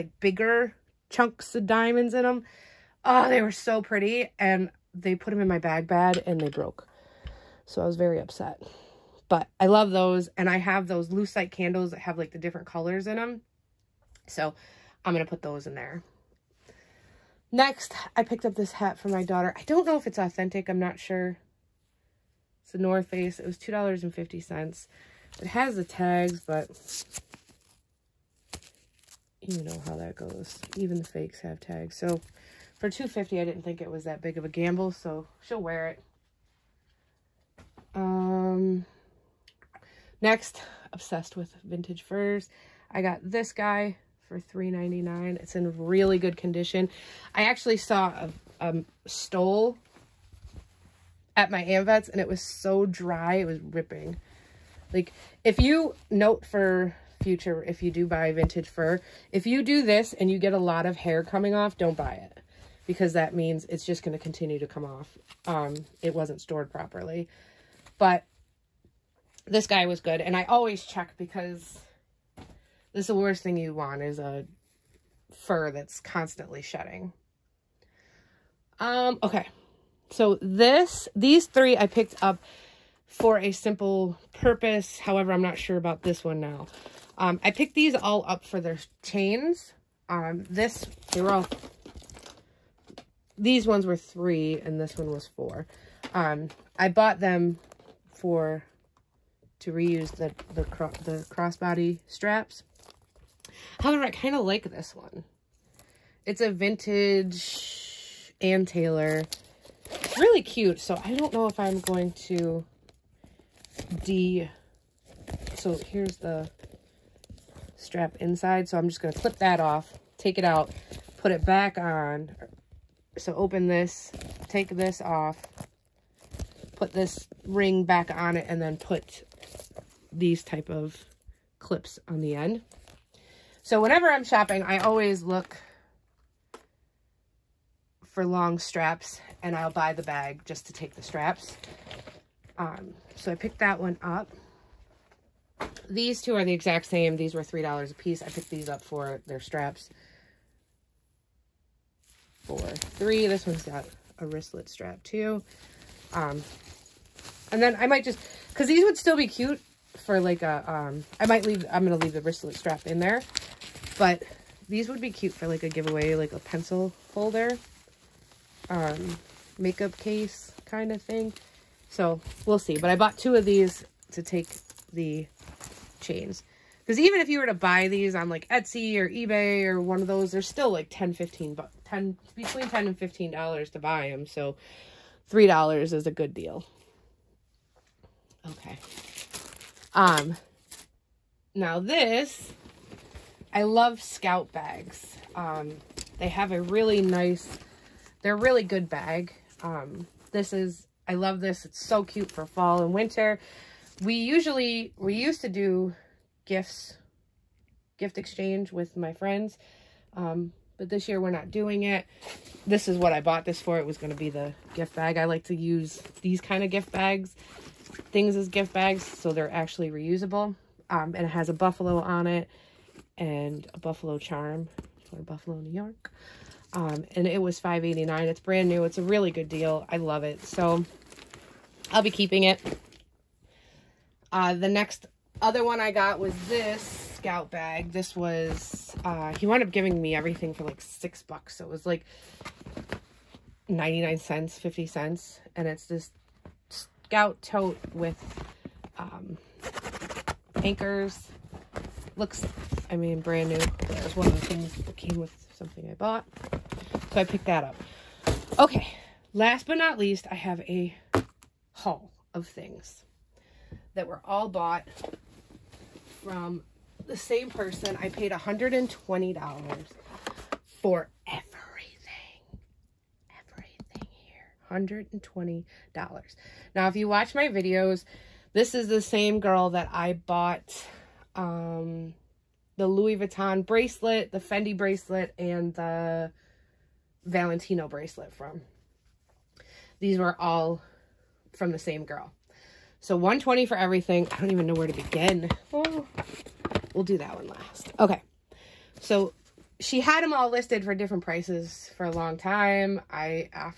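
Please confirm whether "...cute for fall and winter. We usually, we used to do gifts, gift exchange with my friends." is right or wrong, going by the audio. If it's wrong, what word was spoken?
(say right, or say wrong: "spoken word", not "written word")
right.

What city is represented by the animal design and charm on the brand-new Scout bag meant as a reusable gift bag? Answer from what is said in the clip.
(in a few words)
Buffalo, New York.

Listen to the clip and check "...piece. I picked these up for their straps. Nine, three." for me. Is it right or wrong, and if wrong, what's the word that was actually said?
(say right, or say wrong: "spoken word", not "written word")
wrong: "Four", not "Nine".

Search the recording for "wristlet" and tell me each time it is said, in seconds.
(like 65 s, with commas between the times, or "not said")
154 s, 162 s.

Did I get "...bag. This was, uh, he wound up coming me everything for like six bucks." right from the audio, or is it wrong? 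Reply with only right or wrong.
wrong.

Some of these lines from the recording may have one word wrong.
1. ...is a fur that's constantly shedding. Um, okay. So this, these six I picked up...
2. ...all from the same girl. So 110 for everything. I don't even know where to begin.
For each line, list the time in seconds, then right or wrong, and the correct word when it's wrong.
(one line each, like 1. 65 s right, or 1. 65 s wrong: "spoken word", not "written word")
1. 74 s wrong: "three", not "six"
2. 290 s wrong: "120", not "110".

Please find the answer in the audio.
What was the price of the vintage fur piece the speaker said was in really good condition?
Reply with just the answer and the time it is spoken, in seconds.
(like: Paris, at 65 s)
$3.99, at 44 s.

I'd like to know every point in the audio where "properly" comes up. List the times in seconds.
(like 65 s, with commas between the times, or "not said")
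66 s.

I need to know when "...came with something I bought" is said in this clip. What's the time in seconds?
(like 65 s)
254 s.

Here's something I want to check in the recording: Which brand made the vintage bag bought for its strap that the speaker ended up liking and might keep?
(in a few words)
Ann Taylor.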